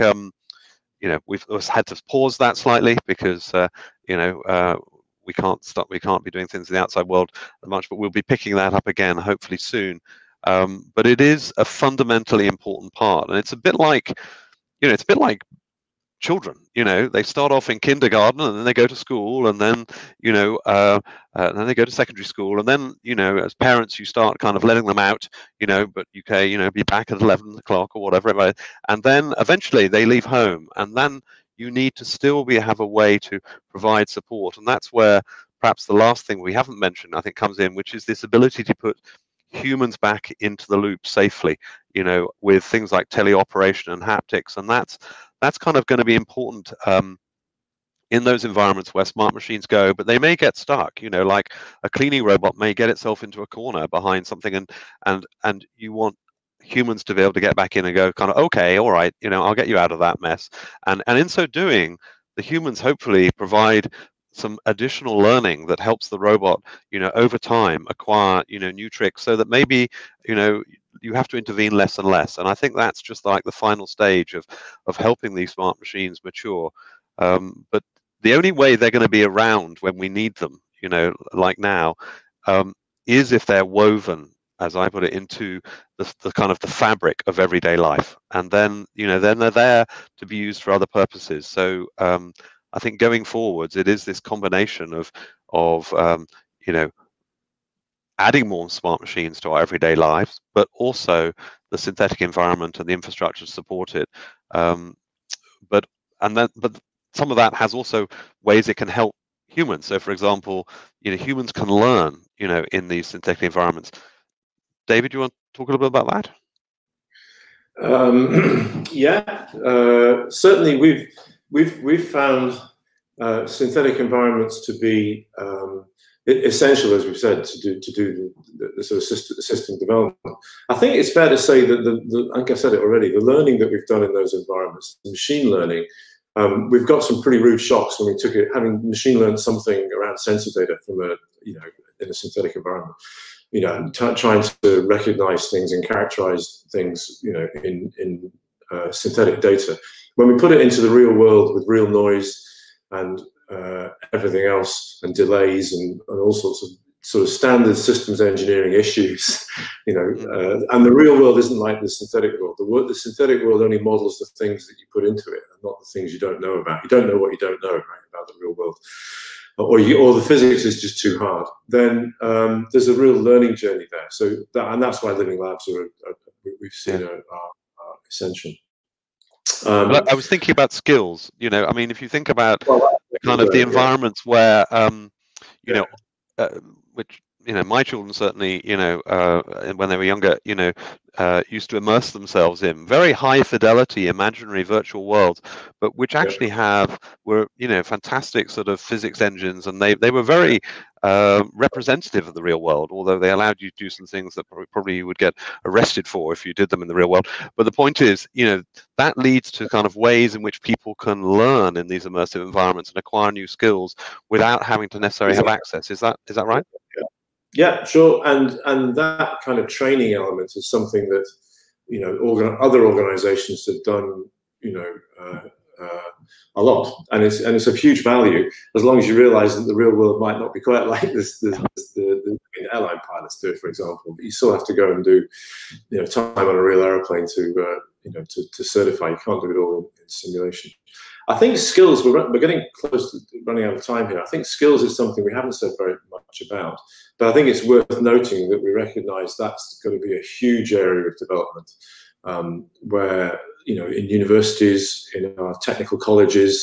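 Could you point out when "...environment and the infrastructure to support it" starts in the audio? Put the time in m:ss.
1:42.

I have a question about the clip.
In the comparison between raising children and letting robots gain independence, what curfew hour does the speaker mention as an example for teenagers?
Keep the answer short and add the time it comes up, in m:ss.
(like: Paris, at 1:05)
11 o'clock, at 0:27.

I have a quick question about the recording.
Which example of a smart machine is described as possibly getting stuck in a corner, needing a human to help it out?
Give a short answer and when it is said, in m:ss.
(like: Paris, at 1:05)
cleaning robot, at 0:51.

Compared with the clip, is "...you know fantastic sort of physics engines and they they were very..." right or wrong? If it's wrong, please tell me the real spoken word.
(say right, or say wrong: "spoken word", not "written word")
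right.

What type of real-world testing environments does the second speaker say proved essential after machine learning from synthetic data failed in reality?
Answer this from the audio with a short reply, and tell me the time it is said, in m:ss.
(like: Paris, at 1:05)
living labs, at 2:55.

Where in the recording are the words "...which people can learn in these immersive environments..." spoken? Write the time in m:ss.
3:30.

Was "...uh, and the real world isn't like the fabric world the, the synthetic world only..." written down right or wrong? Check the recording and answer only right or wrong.
wrong.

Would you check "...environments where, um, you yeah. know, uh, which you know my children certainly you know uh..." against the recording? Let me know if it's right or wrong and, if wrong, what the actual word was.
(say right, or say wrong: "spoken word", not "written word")
right.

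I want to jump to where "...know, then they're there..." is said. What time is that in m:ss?
1:29.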